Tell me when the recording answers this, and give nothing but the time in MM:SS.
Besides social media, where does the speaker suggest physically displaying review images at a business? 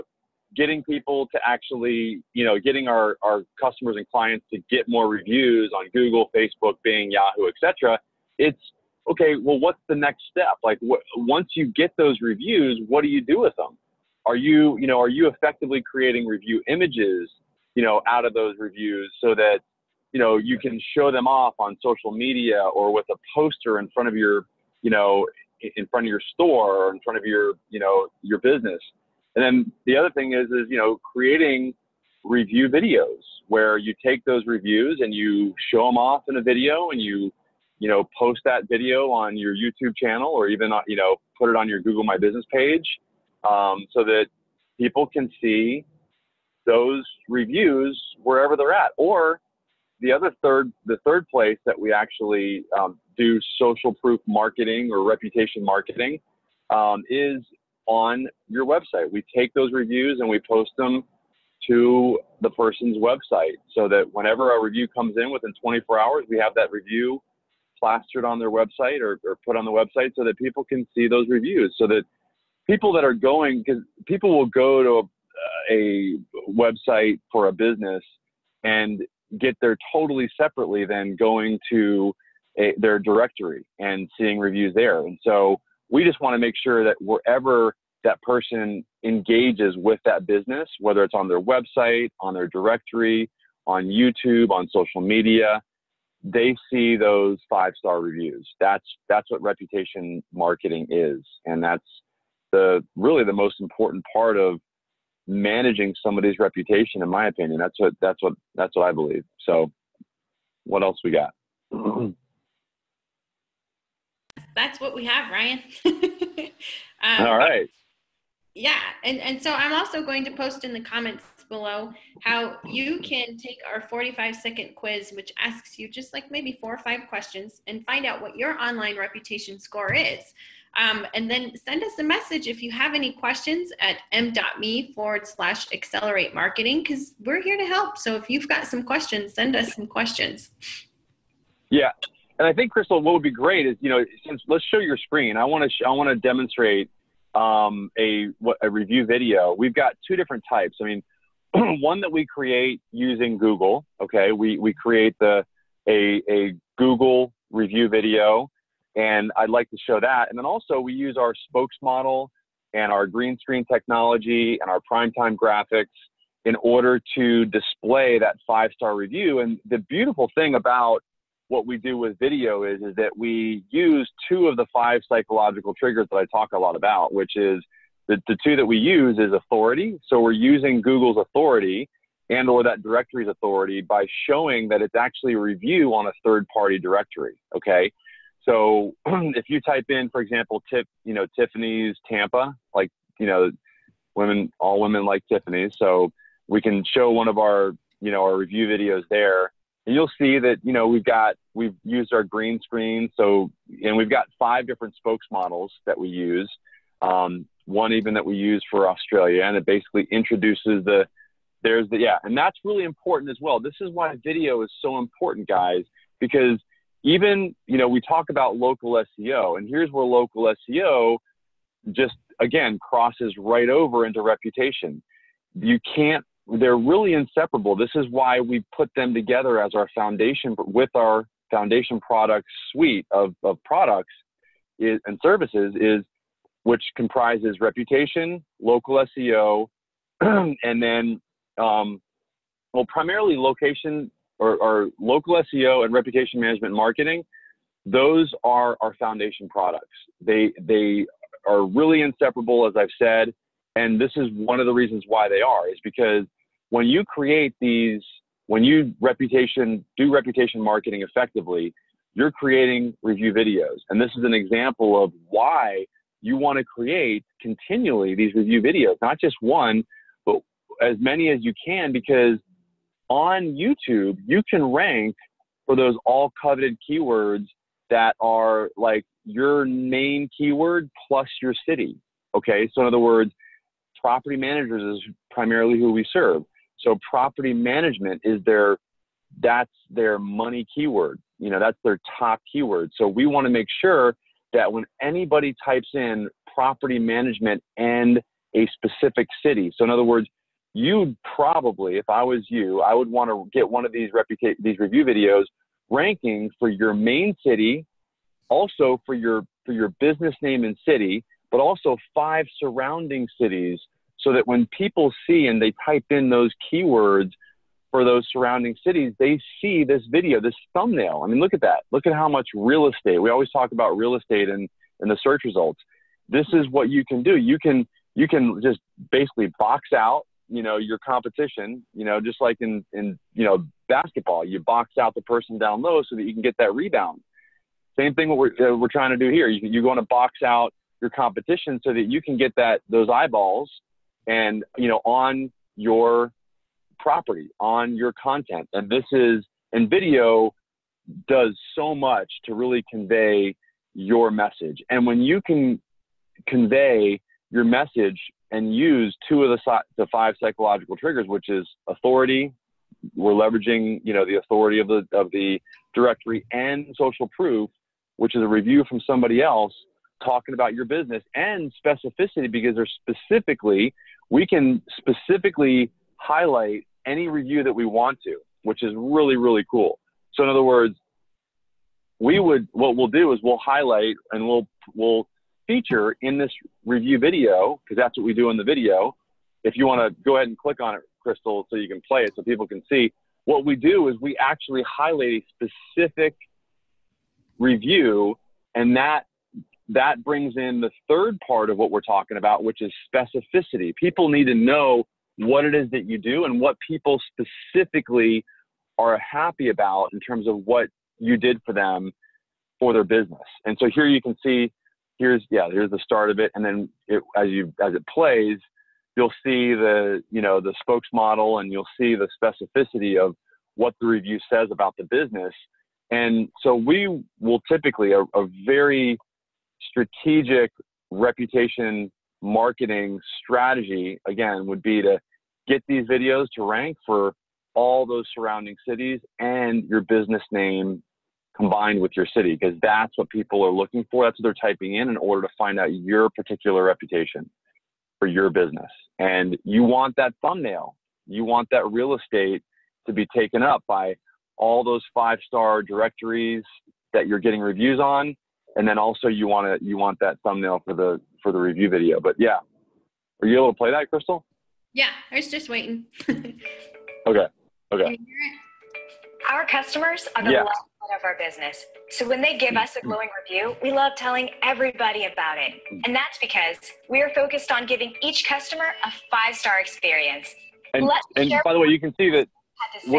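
00:23.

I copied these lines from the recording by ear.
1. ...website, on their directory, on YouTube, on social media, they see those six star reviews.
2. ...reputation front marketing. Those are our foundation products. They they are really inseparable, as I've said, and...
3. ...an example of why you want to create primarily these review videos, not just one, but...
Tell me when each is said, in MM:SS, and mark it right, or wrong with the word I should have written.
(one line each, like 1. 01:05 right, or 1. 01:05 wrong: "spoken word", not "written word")
1. 01:31 wrong: "five", not "six"
2. 04:05 wrong: "management", not "front"
3. 04:24 wrong: "continually", not "primarily".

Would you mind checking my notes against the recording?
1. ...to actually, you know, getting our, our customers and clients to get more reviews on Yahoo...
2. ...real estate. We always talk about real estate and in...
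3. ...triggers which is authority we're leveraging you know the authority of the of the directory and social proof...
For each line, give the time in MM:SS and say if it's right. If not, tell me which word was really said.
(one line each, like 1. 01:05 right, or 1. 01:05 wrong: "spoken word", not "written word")
1. 00:01 wrong: "Google", not "Yahoo"
2. 05:22 right
3. 06:00 right.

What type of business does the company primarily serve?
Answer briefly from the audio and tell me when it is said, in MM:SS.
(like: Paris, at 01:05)
property managers, at 04:43.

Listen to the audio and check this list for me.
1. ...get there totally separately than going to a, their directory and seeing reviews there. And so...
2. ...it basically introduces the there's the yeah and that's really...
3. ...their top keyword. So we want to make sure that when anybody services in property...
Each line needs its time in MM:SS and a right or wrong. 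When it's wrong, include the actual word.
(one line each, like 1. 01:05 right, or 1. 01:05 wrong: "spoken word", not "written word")
1. 01:19 right
2. 03:29 right
3. 04:51 wrong: "types", not "services".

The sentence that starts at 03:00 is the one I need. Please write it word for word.
So we're using Google's authority and or that directory's authority by showing that it's actually a review on a third party directory.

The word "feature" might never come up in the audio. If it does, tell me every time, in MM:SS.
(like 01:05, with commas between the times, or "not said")
06:25.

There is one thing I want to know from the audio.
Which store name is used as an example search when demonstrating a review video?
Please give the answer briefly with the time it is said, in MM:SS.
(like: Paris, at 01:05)
Tiffany's Tampa, at 03:11.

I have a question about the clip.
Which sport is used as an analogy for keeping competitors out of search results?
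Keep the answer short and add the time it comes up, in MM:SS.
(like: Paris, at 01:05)
basketball, at 05:33.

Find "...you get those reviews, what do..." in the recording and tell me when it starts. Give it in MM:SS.
00:11.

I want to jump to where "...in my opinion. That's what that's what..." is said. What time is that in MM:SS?
01:47.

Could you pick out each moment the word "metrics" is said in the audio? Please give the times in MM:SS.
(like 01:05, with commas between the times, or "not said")
not said.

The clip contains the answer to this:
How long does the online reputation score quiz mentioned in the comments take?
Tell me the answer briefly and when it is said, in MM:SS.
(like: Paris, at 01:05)
45 seconds, at 02:03.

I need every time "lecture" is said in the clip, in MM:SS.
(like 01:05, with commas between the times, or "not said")
not said.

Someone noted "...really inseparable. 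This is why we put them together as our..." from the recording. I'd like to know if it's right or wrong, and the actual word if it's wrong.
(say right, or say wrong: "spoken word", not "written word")
right.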